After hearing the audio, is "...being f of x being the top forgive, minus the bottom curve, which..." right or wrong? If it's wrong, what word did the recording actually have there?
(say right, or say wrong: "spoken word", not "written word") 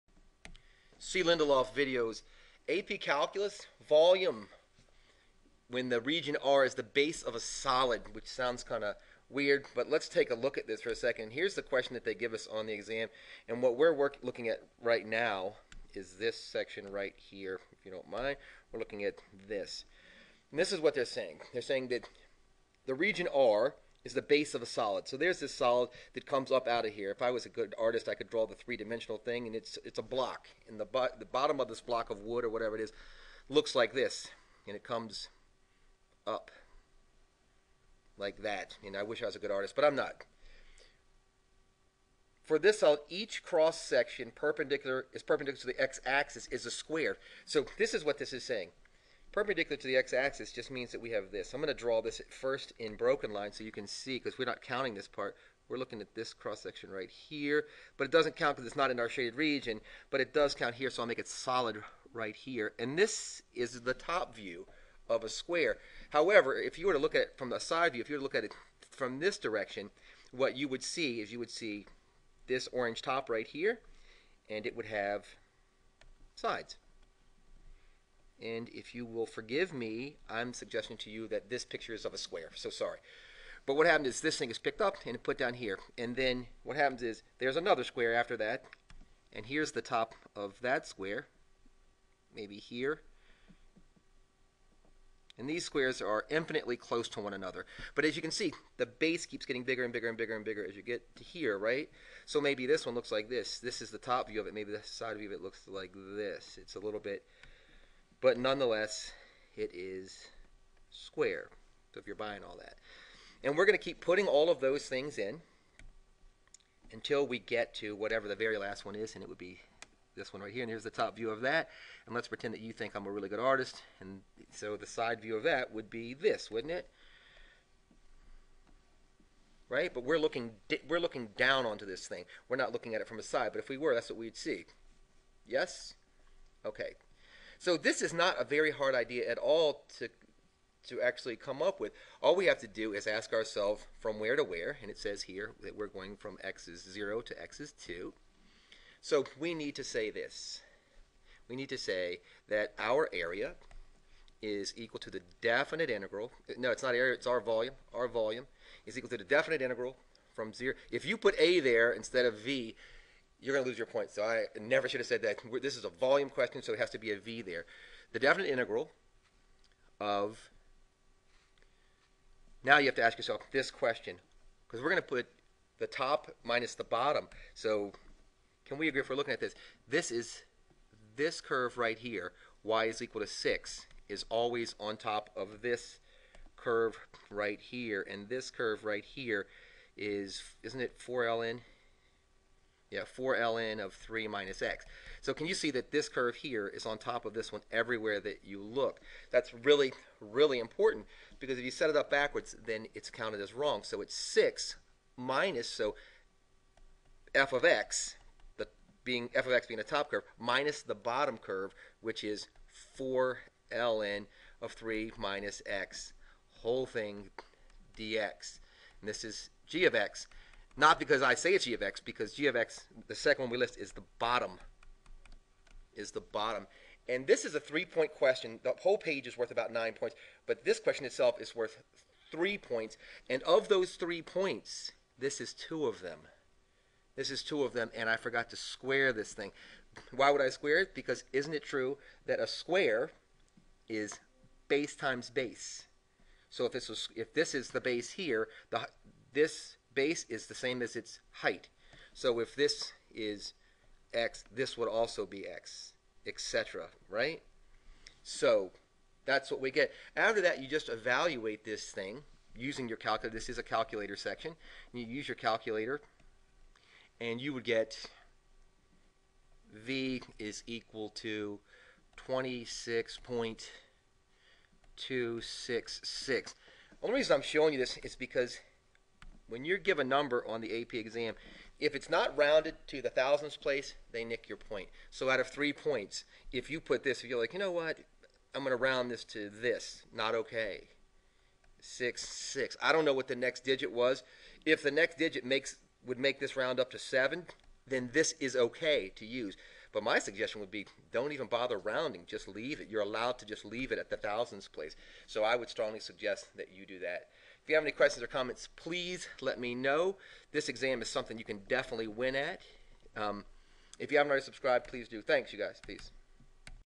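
wrong: "curve", not "forgive".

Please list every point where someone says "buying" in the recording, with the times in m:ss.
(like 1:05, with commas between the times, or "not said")
1:52.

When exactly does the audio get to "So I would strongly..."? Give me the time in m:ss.
5:05.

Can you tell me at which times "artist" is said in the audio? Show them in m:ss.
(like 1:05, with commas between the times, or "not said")
0:27, 0:39, 2:03.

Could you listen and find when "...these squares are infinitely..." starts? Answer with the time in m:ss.
1:35.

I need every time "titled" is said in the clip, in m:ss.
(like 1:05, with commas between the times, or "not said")
not said.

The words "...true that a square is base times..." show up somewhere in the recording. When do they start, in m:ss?
4:01.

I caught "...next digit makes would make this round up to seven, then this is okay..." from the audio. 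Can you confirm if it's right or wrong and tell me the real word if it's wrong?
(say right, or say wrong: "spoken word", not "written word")
right.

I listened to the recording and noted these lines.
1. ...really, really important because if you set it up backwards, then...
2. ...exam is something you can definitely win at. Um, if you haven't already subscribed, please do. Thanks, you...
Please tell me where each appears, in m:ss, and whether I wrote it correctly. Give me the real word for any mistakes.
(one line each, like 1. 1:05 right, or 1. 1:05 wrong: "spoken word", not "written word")
1. 3:19 right
2. 5:10 right.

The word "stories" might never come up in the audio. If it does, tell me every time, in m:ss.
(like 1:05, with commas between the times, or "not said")
not said.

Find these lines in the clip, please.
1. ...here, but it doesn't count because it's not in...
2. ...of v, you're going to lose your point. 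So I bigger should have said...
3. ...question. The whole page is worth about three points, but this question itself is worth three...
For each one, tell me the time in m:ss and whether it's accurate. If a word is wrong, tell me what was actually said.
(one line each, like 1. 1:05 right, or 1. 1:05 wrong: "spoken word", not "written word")
1. 0:57 right
2. 2:42 wrong: "never", not "bigger"
3. 3:48 wrong: "nine", not "three".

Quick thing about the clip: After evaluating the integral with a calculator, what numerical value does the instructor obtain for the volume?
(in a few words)
26.266.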